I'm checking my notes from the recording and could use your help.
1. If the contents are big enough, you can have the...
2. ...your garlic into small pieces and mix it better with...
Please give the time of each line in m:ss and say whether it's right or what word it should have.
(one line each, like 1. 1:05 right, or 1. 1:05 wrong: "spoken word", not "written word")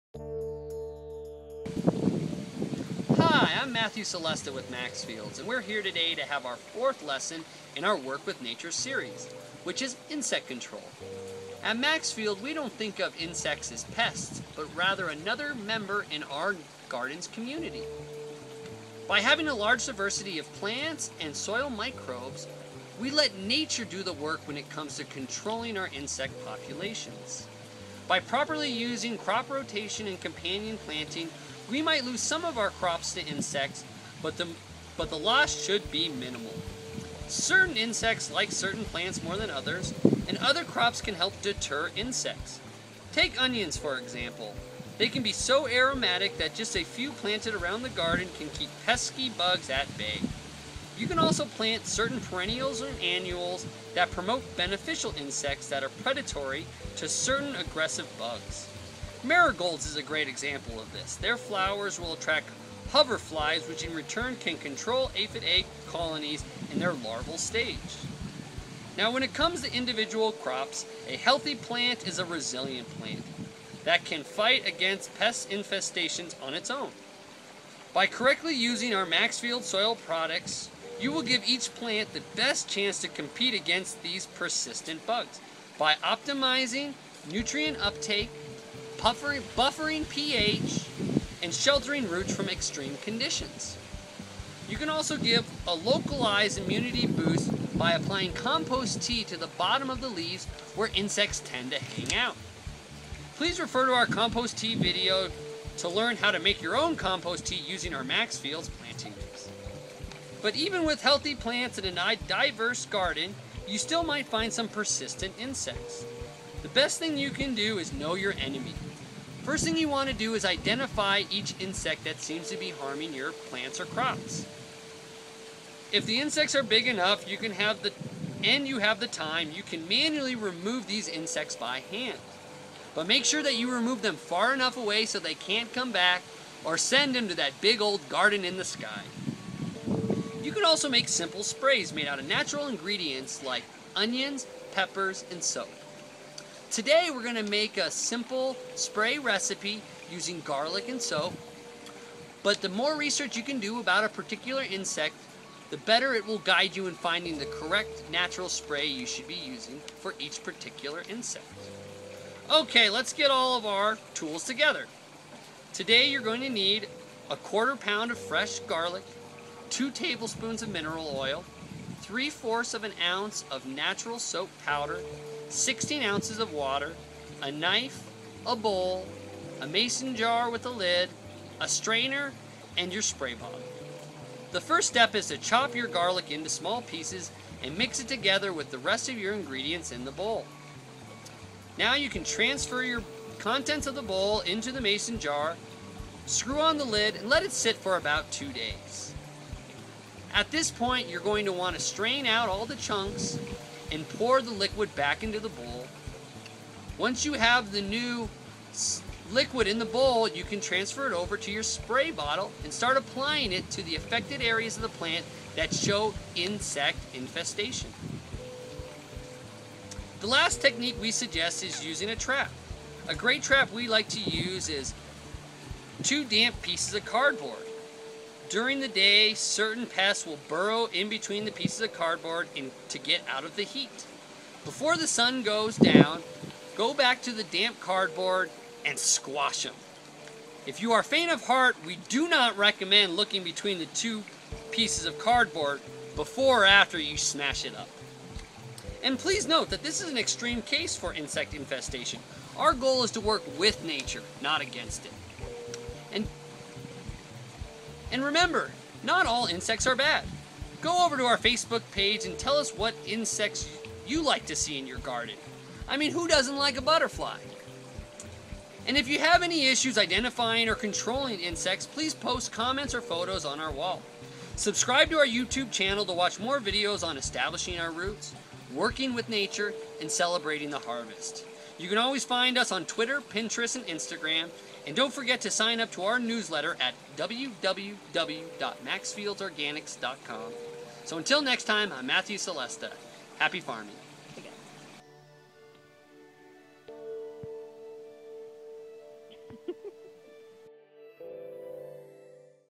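1. 2:05 wrong: "insects", not "contents"
2. 3:05 wrong: "together", not "better".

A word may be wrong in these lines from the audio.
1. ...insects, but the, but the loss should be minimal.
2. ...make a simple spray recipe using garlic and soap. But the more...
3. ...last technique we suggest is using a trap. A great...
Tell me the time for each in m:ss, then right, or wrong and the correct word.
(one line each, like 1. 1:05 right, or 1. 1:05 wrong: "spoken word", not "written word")
1. 0:33 right
2. 2:27 right
3. 3:40 right.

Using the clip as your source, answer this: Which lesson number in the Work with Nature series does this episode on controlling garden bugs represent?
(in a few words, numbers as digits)
4th.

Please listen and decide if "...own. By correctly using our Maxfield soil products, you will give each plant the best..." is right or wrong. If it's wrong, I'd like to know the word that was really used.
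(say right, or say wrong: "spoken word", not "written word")
right.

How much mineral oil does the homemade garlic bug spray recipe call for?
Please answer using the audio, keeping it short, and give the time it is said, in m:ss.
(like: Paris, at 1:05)
2 tablespoons, at 2:49.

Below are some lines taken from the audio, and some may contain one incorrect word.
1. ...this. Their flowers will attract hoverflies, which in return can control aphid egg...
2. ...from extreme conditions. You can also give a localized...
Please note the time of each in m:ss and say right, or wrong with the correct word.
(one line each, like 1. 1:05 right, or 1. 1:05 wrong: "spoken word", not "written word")
1. 1:00 right
2. 1:32 right.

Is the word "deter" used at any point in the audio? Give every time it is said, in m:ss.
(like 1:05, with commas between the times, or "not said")
0:41.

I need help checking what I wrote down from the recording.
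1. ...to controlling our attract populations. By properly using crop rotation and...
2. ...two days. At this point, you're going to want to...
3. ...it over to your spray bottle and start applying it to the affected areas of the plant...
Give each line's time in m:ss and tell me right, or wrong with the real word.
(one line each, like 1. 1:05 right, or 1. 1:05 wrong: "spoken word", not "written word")
1. 0:24 wrong: "insect", not "attract"
2. 3:18 right
3. 3:31 right.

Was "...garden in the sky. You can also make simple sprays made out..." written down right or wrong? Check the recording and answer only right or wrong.
right.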